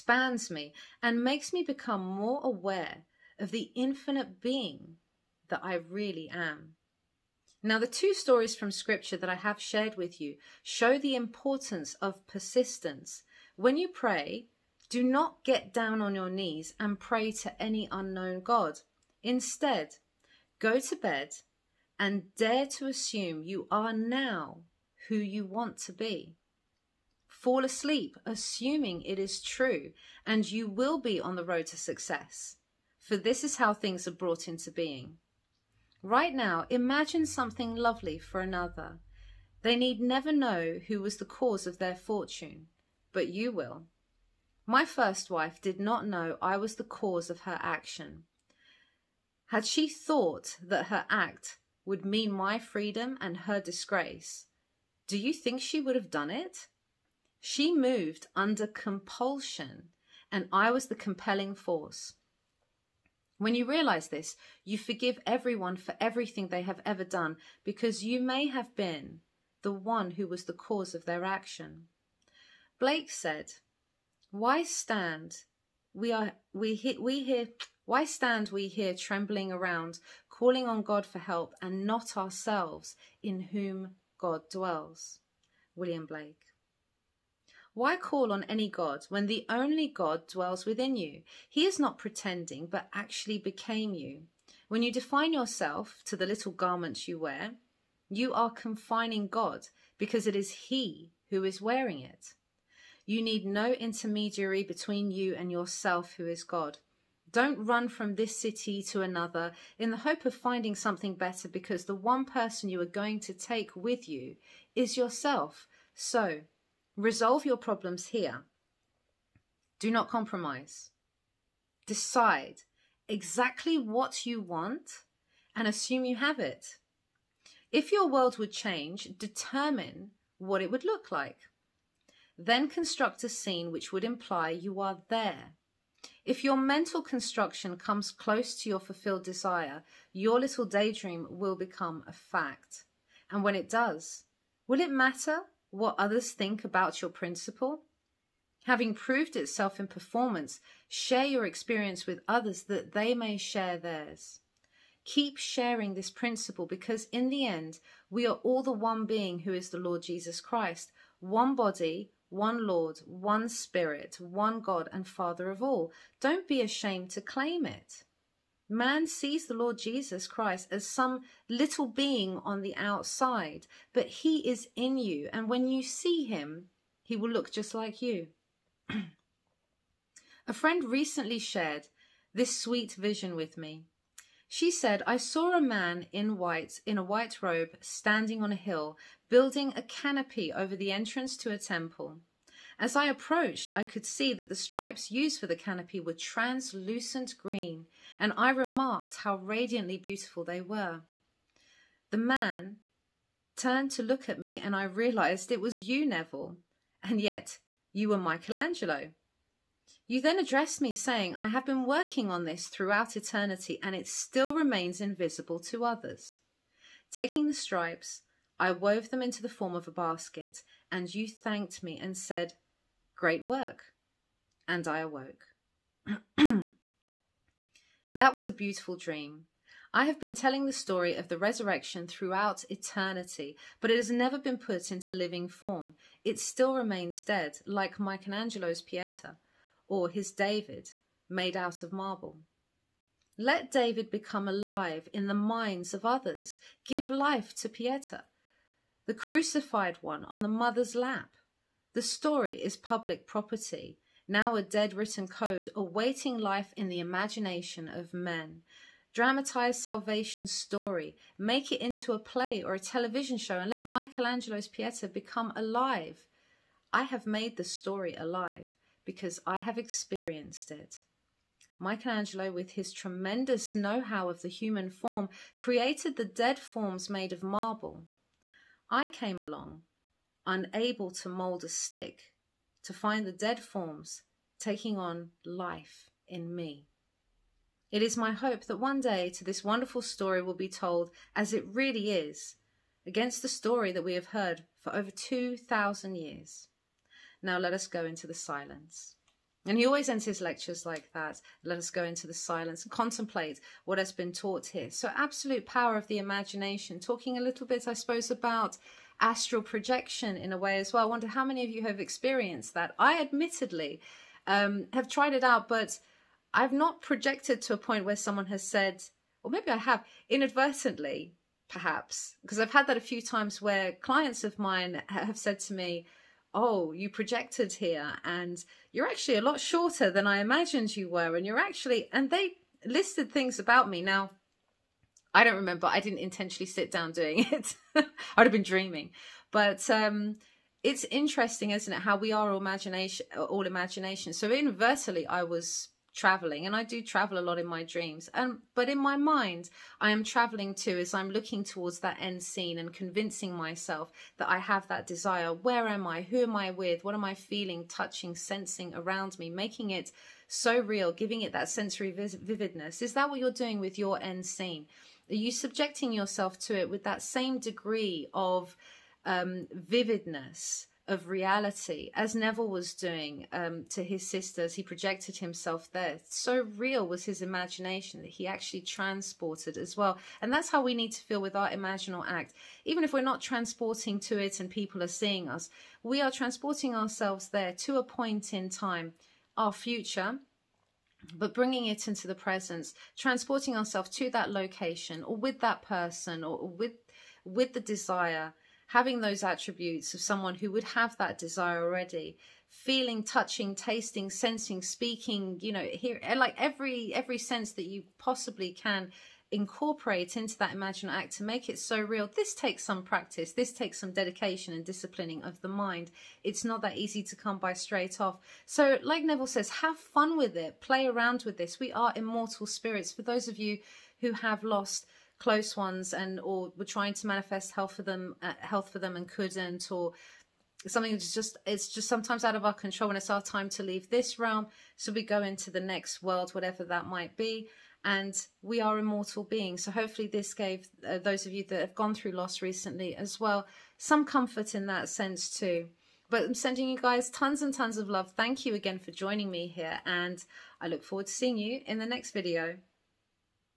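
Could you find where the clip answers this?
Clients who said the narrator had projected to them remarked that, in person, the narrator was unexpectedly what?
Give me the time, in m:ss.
5:29.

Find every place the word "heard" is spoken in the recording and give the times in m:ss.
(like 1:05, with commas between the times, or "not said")
4:54.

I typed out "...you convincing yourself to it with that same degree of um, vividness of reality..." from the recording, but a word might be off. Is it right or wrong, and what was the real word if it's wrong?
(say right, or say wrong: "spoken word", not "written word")
wrong: "subjecting", not "convincing".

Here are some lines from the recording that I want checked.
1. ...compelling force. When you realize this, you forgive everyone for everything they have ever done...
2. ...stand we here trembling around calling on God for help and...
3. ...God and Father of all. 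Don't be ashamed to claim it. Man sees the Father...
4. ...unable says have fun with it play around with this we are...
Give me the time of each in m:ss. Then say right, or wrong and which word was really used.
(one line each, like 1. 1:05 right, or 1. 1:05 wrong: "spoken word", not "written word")
1. 1:01 right
2. 1:18 right
3. 2:44 wrong: "Lord", not "Father"
4. 6:59 wrong: "neville", not "unable".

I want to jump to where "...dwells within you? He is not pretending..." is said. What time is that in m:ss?
1:30.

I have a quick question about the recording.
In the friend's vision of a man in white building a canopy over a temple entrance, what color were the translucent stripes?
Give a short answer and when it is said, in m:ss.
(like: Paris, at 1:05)
Green, at 3:16.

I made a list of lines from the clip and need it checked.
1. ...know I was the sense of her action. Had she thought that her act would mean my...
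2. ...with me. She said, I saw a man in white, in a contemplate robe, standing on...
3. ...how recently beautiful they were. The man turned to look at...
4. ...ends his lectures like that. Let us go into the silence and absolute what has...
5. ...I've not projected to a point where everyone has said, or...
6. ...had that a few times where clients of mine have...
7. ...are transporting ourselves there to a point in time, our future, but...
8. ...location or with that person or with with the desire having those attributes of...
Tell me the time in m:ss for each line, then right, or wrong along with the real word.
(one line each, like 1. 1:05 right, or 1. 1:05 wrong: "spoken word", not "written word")
1. 0:46 wrong: "cause", not "sense"
2. 3:03 wrong: "white", not "contemplate"
3. 3:19 wrong: "radiantly", not "recently"
4. 5:00 wrong: "contemplate", not "absolute"
5. 5:16 wrong: "someone", not "everyone"
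6. 5:22 right
7. 6:26 right
8. 6:34 right.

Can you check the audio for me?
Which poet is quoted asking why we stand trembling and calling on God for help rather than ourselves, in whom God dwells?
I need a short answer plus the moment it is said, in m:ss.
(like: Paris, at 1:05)
William Blake, at 1:25.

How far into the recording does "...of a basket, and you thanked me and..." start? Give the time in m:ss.
3:39.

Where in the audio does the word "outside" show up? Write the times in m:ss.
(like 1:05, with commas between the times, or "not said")
2:52.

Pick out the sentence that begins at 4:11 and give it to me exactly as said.
The story is public property, now a dead written code awaiting life in the imagination of men.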